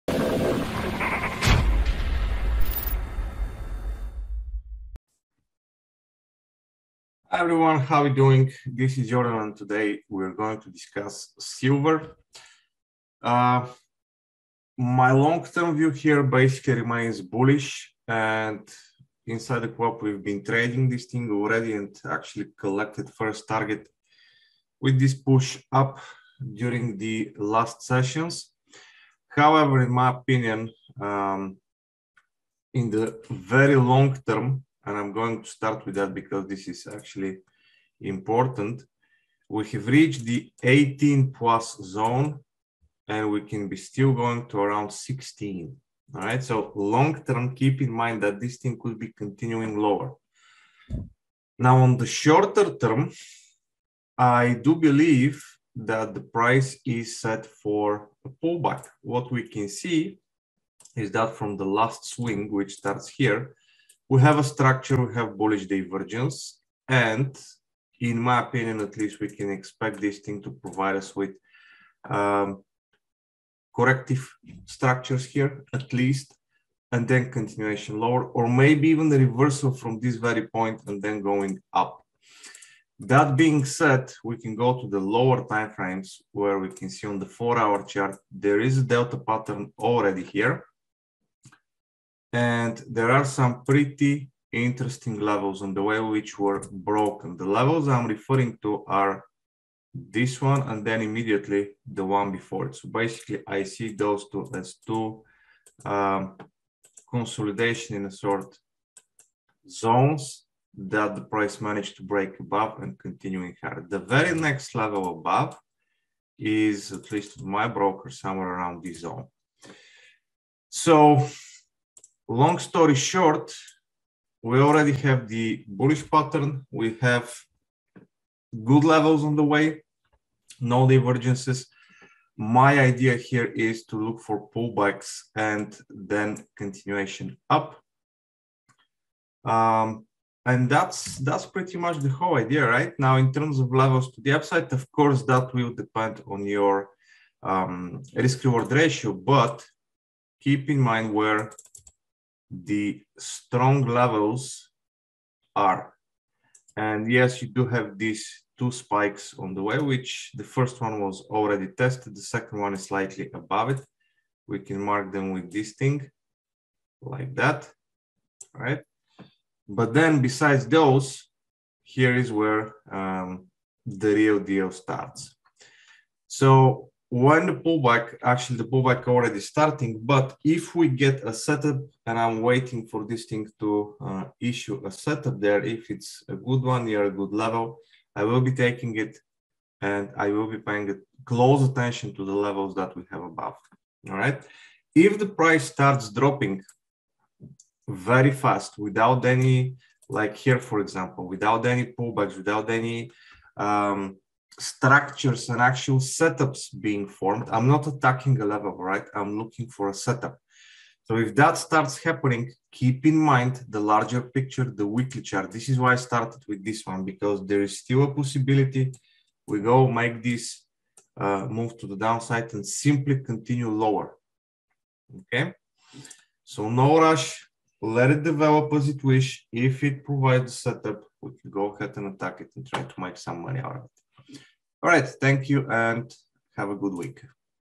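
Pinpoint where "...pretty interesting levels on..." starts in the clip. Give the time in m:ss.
1:33.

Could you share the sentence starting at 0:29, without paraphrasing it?
However, in my opinion, um, in the very long term, and I'm going to start with that because this is actually important.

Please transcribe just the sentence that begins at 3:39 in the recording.
We go make this uh, move to the downside and simply continue lower.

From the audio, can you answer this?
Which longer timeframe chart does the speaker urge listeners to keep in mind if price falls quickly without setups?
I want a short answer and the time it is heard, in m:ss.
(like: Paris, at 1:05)
weekly chart, at 3:34.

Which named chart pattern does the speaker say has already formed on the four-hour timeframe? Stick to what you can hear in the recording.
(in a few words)
delta pattern.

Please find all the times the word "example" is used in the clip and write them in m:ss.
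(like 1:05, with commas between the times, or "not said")
3:20.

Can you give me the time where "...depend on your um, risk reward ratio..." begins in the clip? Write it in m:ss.
2:25.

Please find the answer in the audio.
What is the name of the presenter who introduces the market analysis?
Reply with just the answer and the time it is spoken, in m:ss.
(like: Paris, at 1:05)
Jordan, at 0:09.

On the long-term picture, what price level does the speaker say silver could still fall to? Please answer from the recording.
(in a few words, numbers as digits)
16.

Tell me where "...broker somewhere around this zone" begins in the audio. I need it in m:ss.
1:57.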